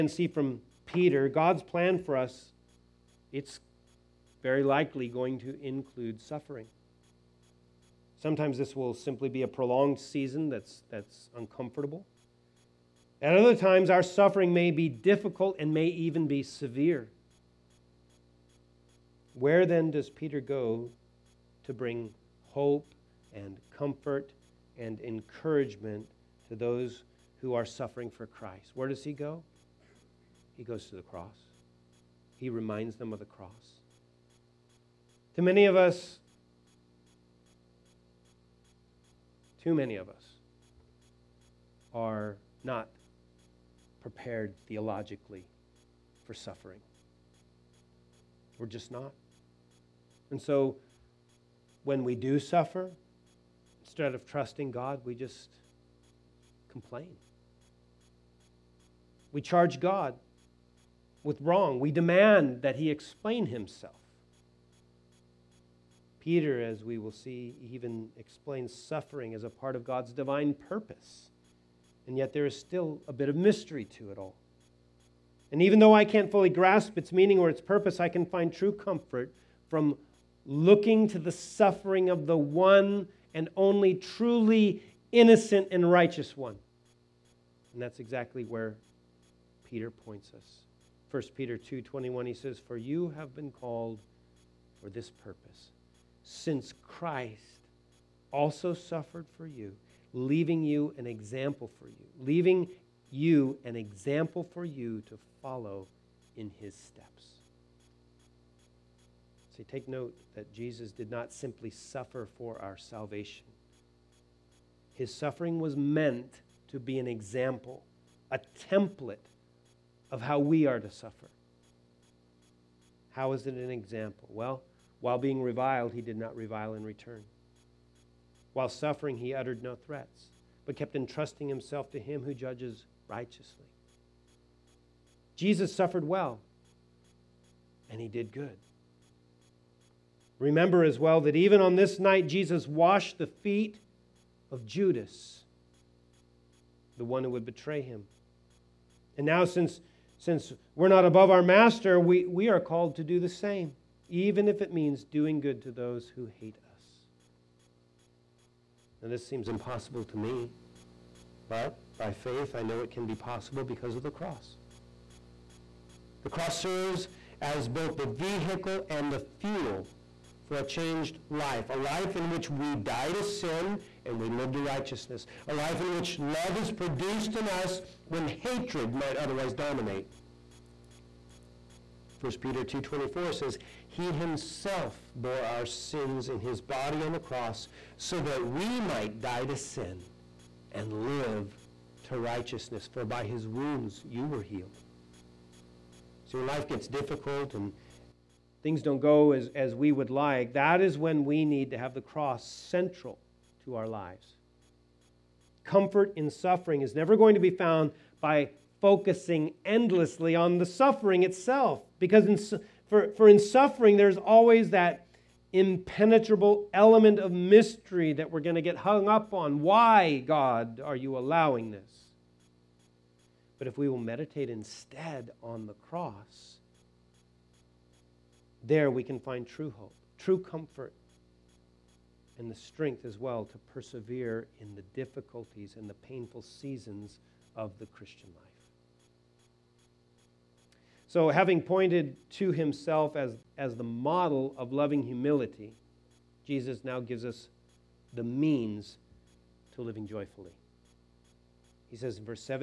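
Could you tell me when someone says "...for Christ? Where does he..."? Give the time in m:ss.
0:28.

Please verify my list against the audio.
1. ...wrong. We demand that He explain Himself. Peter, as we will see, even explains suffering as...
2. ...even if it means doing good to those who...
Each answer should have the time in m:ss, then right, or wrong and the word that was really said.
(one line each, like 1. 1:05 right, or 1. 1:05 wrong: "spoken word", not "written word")
1. 1:01 right
2. 2:34 right.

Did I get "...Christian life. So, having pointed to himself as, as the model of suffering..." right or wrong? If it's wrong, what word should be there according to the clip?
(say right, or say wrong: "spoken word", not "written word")
wrong: "loving", not "suffering".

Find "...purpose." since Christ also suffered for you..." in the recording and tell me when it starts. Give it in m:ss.
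1:35.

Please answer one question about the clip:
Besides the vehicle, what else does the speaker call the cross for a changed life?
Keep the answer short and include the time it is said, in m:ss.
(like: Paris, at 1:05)
the fuel, at 2:49.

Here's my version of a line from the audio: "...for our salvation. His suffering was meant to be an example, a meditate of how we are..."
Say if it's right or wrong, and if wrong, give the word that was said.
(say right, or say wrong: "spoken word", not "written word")
wrong: "template", not "meditate".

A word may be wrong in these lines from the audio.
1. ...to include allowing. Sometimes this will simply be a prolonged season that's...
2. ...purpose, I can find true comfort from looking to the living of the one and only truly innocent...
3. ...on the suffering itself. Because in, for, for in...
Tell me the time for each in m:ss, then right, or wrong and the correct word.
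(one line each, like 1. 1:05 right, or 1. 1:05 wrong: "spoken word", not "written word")
1. 0:05 wrong: "suffering", not "allowing"
2. 1:17 wrong: "suffering", not "living"
3. 3:30 right.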